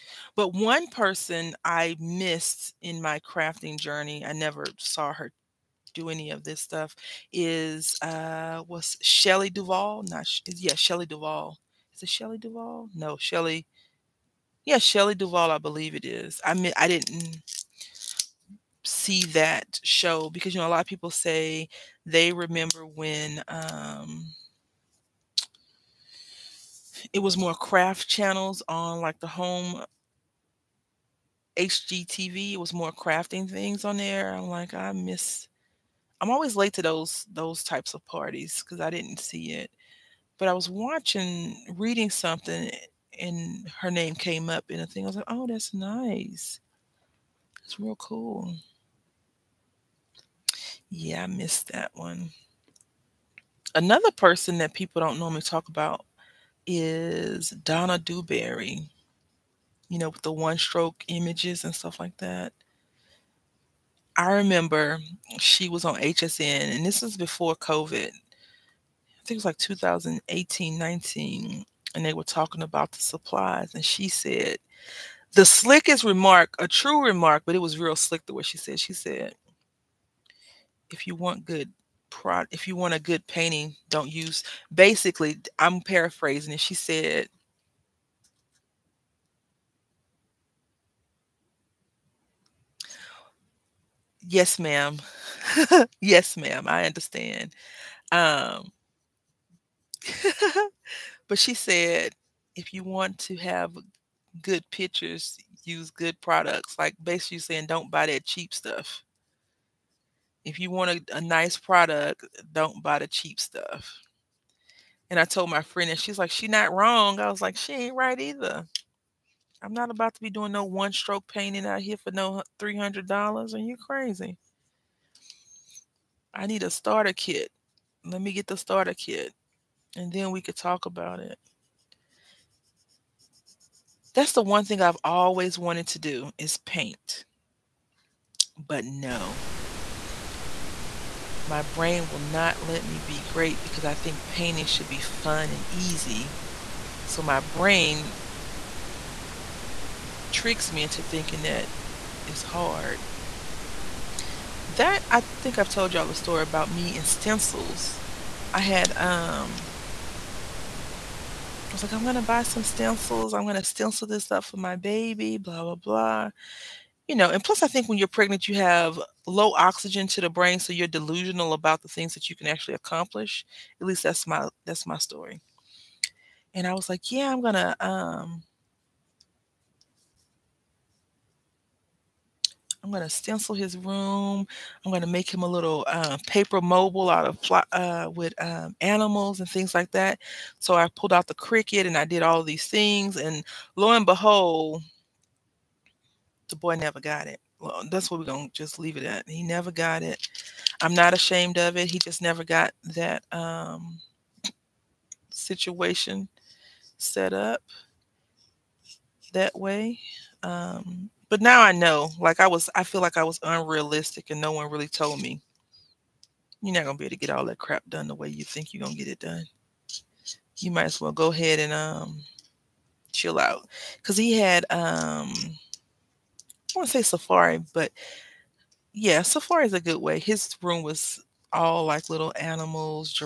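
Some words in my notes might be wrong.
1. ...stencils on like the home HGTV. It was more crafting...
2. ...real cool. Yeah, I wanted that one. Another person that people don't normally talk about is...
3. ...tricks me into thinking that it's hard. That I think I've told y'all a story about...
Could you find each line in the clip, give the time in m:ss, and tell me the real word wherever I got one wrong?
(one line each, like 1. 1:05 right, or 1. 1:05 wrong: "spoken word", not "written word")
1. 0:28 wrong: "channels", not "stencils"
2. 0:47 wrong: "missed", not "wanted"
3. 2:30 right.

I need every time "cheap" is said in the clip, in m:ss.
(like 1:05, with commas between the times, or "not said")
1:48, 1:53.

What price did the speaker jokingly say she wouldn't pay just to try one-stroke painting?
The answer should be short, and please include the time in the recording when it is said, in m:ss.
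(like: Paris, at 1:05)
$300, at 2:02.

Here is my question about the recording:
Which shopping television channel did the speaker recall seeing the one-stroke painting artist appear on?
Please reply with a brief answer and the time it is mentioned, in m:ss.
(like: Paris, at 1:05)
HSN, at 1:05.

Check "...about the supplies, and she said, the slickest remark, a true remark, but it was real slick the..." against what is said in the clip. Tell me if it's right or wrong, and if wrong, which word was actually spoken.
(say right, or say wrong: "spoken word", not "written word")
right.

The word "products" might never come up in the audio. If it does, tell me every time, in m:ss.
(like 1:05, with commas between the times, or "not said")
1:46, 1:51.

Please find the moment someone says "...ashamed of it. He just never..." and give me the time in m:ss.
3:21.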